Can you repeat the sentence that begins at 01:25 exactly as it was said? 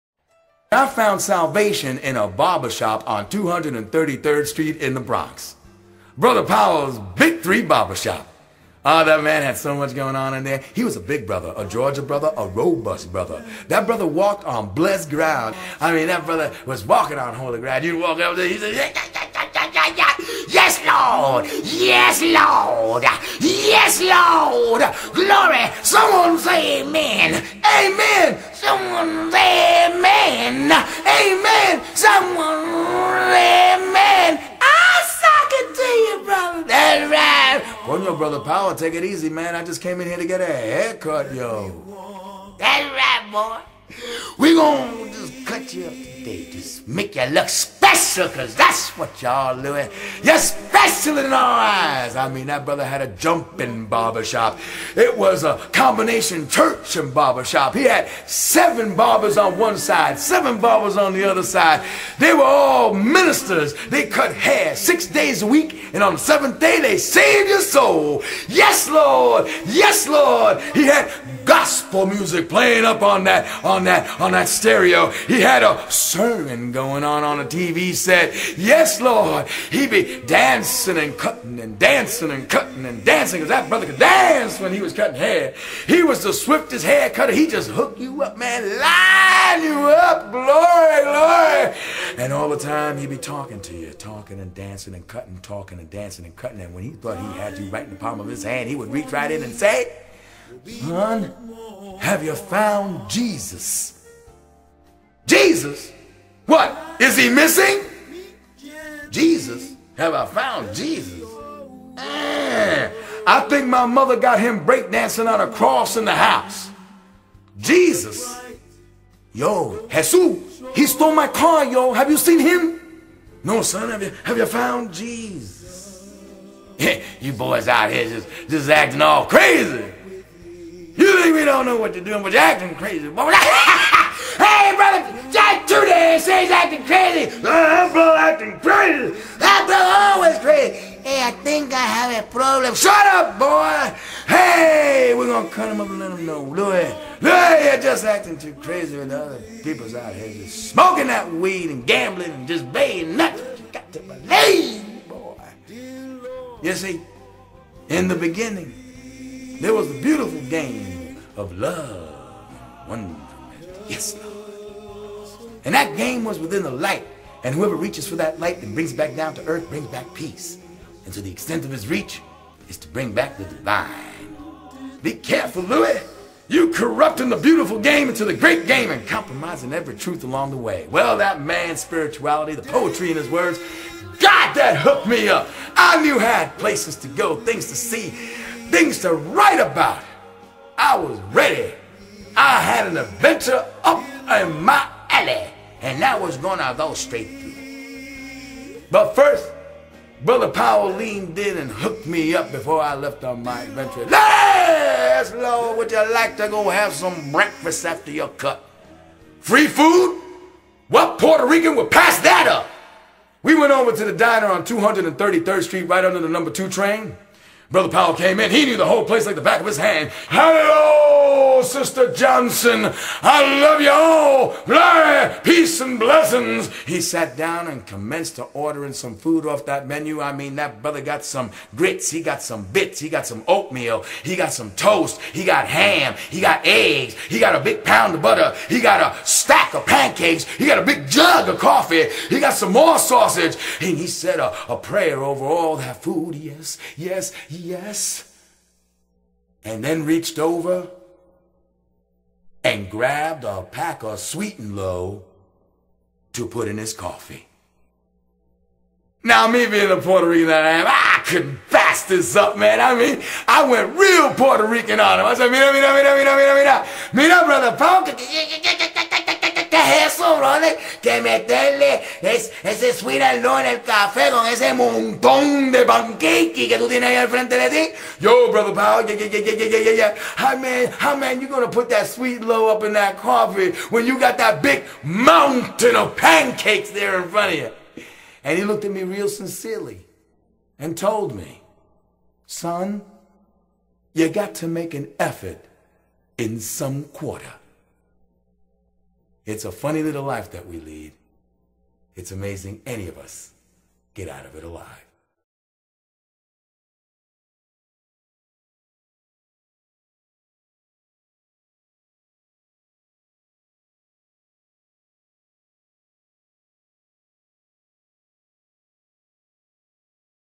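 He was the swiftest hair cutter.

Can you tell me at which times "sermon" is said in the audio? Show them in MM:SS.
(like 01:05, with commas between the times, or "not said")
01:15.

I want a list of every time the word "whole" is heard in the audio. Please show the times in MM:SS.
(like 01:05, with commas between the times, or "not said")
03:38.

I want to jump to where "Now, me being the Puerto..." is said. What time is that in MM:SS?
04:19.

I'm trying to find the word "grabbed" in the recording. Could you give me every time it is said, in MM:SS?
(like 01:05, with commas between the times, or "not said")
04:12.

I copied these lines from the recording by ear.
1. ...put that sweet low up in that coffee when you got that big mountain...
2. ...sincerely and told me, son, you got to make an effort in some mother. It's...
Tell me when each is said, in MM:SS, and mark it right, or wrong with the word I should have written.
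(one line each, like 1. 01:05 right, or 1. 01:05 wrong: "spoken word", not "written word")
1. 04:41 right
2. 04:49 wrong: "quarter", not "mother".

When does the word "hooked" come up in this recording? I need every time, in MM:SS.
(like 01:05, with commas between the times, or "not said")
01:27, 03:04, 03:21.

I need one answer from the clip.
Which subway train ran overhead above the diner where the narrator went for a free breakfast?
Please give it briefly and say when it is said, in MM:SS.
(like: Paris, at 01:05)
number two train, at 03:36.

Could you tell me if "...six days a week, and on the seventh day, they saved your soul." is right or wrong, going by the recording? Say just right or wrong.
right.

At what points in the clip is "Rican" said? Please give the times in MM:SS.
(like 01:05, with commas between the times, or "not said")
03:31, 04:20, 04:24.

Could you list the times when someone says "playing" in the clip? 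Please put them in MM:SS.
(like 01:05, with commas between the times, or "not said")
01:12.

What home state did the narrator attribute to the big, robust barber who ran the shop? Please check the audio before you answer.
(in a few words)
Georgia.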